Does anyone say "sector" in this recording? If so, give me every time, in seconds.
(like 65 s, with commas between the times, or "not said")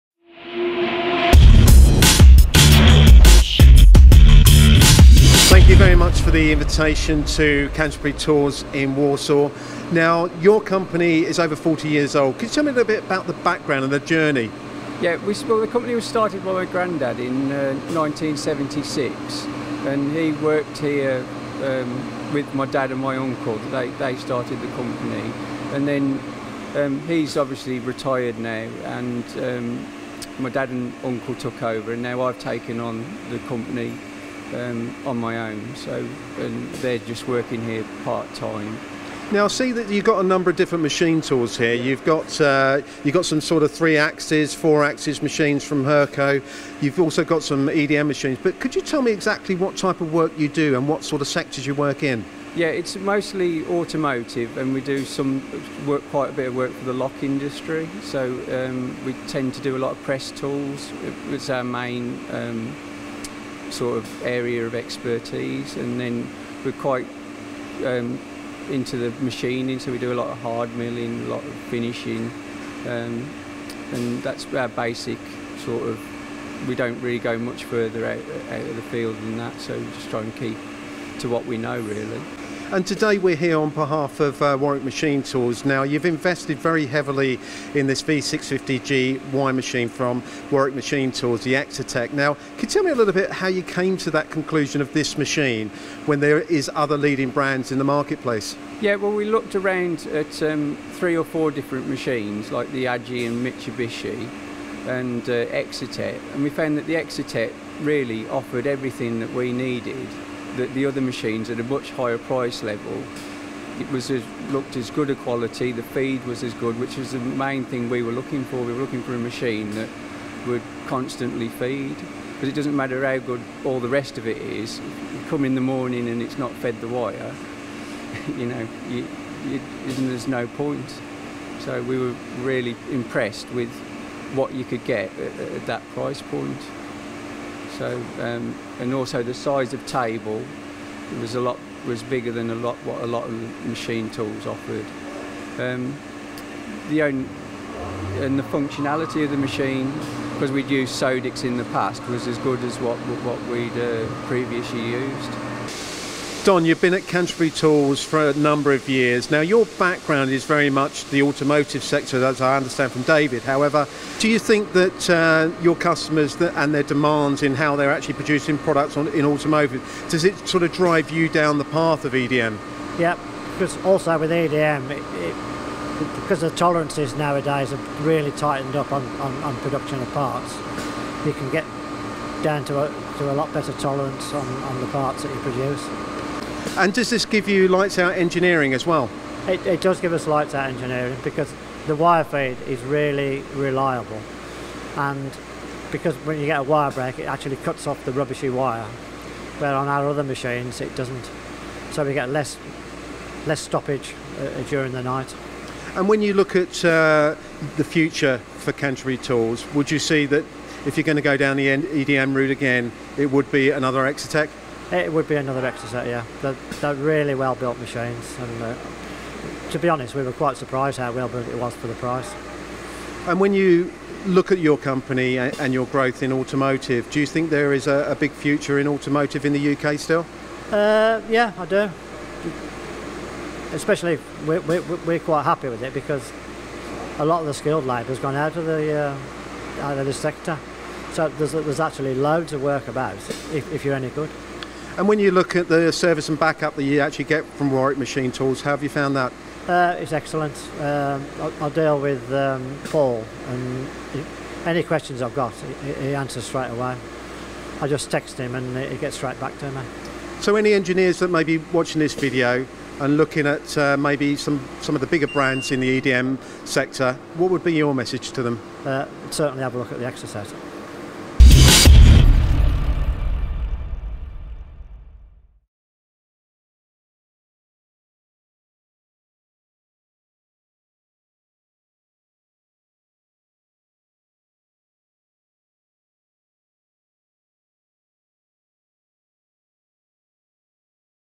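51 s, 161 s, 240 s, 266 s.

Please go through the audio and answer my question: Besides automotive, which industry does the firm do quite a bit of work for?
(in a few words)
Lock industry.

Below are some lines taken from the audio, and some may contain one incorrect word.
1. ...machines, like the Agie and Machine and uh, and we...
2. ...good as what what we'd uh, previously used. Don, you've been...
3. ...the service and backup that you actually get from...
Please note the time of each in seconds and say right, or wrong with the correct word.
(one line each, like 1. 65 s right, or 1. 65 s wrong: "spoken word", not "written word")
1. 101 s wrong: "Mitsubishi", not "Machine"
2. 152 s right
3. 245 s right.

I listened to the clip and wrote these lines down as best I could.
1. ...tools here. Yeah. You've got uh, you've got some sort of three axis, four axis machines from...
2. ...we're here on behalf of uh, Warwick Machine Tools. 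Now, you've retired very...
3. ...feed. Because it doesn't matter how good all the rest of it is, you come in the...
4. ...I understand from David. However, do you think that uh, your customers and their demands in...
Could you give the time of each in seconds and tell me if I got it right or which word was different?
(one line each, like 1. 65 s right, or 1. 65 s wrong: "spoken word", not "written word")
1. 41 s right
2. 83 s wrong: "invested", not "retired"
3. 121 s right
4. 162 s right.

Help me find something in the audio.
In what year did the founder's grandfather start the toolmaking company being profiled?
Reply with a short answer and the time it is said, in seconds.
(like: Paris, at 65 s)
1976, at 17 s.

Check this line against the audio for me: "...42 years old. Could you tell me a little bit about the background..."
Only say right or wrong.
wrong.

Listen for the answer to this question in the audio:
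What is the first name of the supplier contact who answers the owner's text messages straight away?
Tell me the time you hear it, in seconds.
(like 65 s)
252 s.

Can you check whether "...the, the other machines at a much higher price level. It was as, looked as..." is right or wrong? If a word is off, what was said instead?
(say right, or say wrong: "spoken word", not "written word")
right.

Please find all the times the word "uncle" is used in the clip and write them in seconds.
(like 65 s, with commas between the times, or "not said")
23 s, 31 s.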